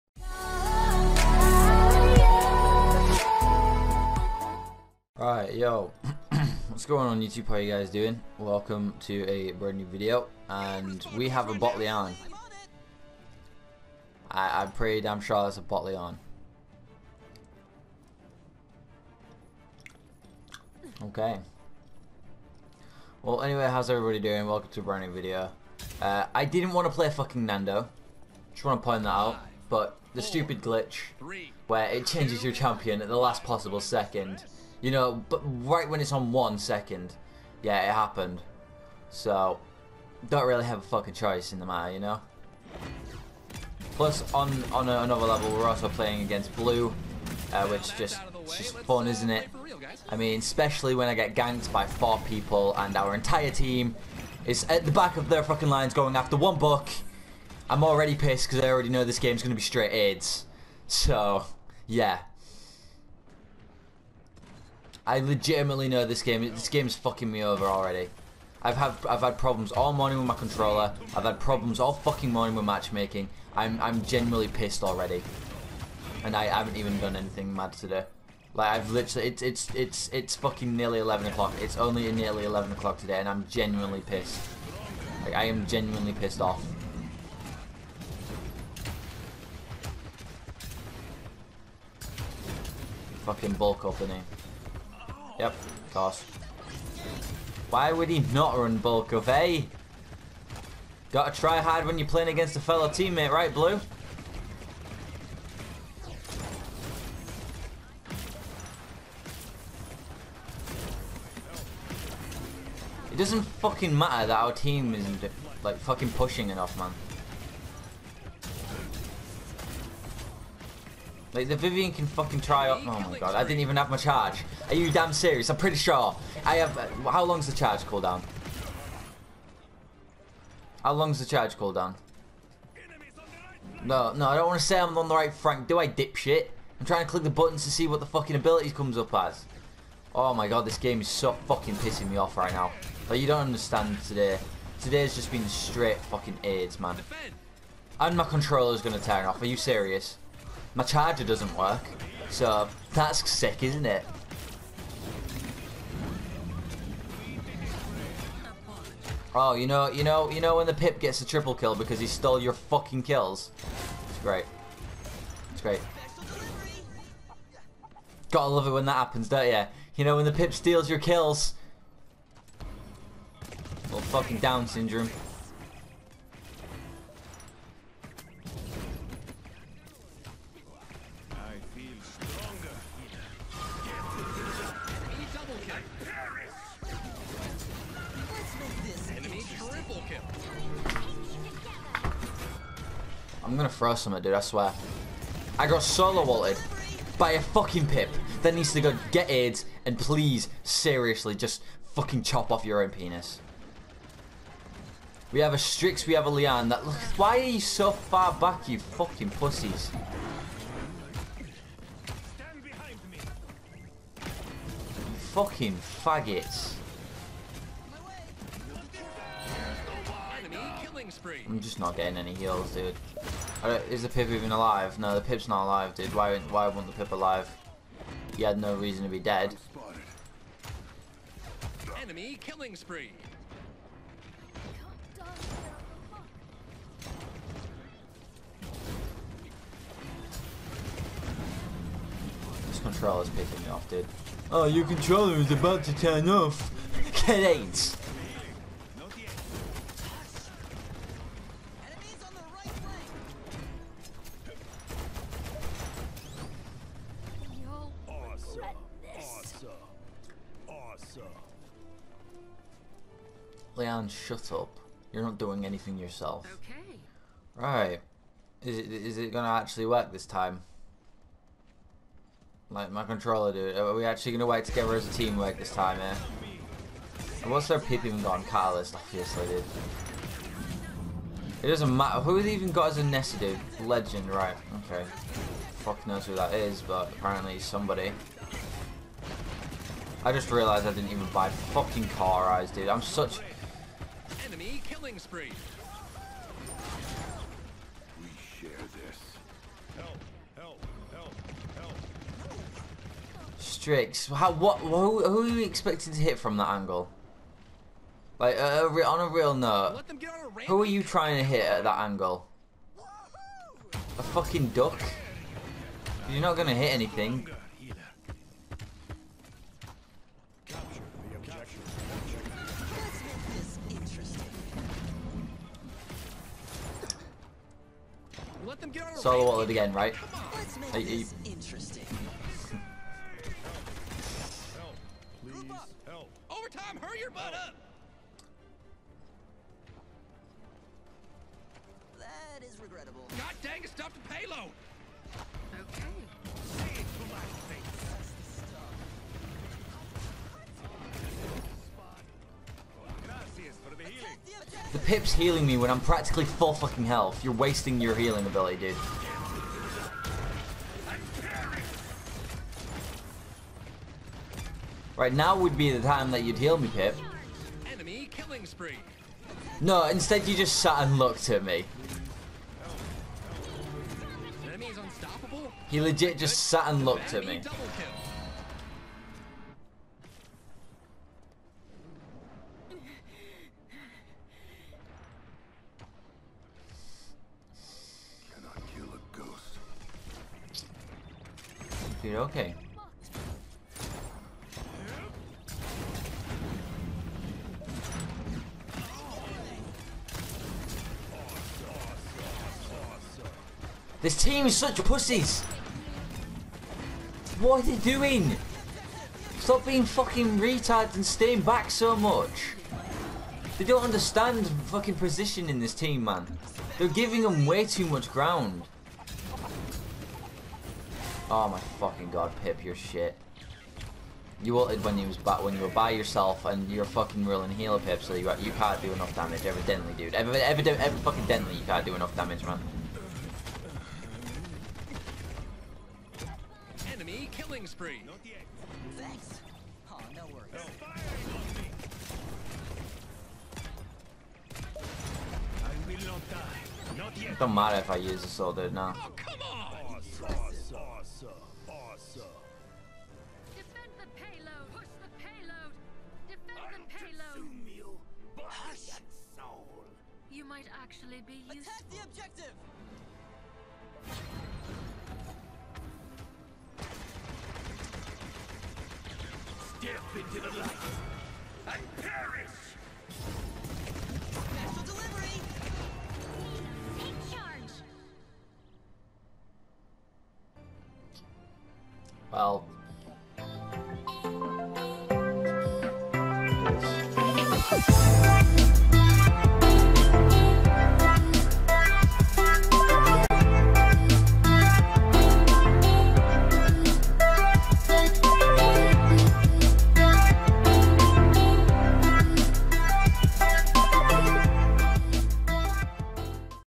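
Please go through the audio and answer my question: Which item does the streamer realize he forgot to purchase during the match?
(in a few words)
Cauterize.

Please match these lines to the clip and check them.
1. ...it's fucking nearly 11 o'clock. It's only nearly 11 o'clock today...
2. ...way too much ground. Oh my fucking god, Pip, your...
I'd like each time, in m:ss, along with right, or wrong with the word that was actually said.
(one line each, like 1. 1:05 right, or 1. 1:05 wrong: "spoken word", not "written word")
1. 1:20 right
2. 6:57 right.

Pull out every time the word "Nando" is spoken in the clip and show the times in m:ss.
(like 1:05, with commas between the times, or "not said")
0:27.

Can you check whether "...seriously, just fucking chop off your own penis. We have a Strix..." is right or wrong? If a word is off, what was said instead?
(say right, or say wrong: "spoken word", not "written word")
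right.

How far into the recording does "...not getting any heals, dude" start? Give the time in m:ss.
3:41.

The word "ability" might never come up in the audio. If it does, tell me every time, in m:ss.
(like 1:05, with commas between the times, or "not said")
2:18, 5:58.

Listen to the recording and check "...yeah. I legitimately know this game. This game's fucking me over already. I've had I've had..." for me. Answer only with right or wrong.
right.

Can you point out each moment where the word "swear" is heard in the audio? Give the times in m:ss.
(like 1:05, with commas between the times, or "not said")
3:14.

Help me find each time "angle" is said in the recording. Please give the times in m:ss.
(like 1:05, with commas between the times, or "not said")
5:06, 5:11.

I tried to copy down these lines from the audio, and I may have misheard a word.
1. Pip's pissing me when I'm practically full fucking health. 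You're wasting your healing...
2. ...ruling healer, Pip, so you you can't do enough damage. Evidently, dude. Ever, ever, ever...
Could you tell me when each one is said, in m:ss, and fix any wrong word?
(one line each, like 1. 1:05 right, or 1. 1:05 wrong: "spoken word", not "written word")
1. 5:55 wrong: "healing", not "pissing"
2. 7:07 right.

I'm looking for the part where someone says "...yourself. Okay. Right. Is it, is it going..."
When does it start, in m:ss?
4:25.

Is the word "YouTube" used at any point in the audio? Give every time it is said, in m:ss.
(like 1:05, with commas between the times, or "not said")
0:07.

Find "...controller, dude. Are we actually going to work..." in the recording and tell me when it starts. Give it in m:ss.
4:33.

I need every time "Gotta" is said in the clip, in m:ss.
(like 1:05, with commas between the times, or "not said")
1:41, 2:48.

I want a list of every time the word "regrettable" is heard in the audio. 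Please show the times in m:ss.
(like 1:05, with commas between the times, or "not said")
5:42.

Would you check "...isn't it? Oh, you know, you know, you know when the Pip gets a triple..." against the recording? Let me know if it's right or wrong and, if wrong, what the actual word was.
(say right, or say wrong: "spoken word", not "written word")
right.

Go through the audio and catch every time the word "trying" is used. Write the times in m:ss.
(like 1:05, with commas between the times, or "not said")
2:16, 5:11.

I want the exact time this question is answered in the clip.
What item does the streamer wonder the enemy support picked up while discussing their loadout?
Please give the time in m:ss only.
4:38.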